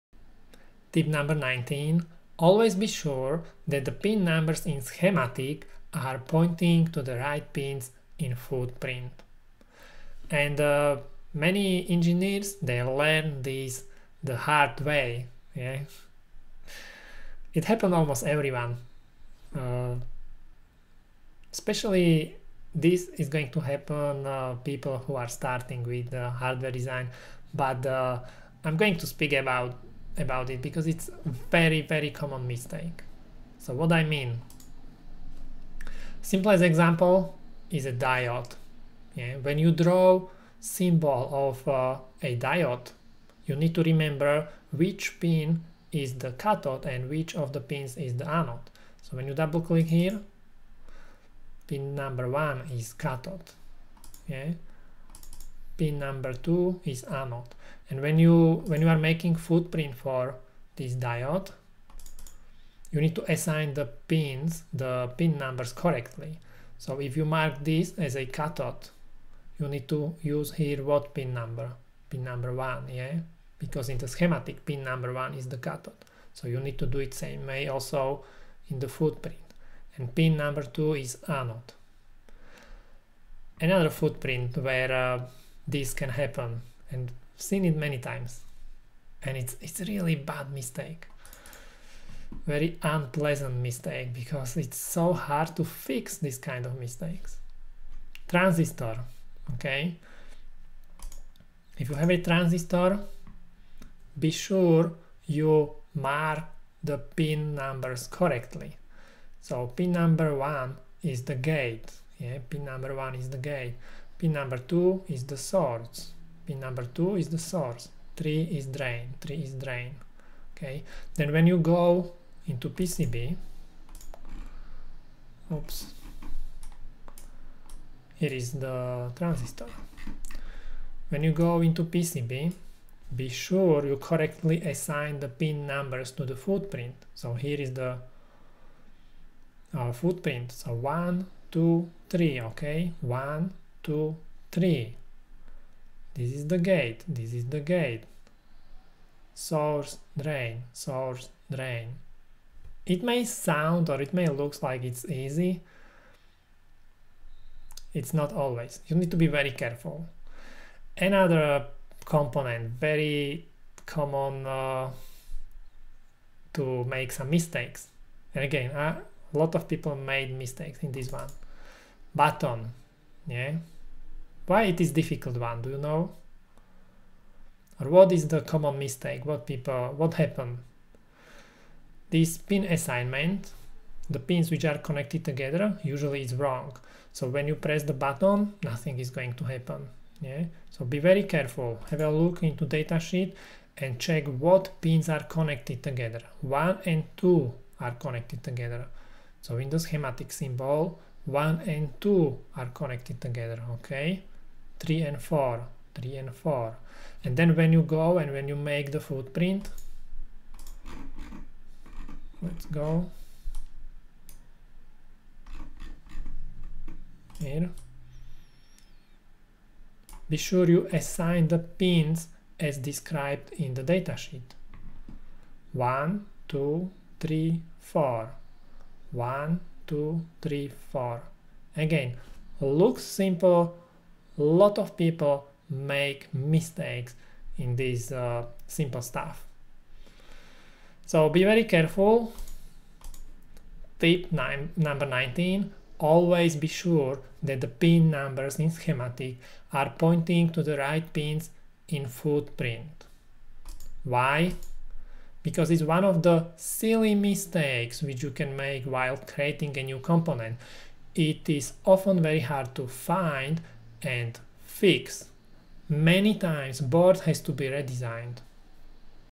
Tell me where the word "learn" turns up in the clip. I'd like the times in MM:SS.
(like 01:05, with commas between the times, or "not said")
00:12.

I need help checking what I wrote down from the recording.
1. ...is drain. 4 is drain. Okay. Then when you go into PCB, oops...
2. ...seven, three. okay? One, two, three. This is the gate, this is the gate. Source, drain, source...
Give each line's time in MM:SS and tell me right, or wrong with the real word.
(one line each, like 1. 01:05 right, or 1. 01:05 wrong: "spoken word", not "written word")
1. 01:58 wrong: "3", not "4"
2. 02:21 wrong: "two", not "seven".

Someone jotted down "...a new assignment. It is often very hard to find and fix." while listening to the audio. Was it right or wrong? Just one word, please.
wrong.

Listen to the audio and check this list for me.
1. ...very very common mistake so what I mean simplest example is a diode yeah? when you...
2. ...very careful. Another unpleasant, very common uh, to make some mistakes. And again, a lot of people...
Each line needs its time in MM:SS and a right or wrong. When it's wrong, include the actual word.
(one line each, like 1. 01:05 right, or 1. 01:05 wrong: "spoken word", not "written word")
1. 00:31 right
2. 02:39 wrong: "component", not "unpleasant".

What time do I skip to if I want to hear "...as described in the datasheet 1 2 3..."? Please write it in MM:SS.
03:42.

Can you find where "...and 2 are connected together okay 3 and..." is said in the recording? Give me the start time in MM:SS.
03:21.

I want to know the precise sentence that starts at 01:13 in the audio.
Because in the schematic, pin number one is the cathode.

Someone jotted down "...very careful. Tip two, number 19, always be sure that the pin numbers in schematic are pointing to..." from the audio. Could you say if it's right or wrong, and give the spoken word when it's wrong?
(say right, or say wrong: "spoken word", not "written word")
wrong: "nine", not "two".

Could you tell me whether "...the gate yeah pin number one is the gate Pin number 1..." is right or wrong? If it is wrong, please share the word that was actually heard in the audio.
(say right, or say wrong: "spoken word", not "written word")
wrong: "2", not "1".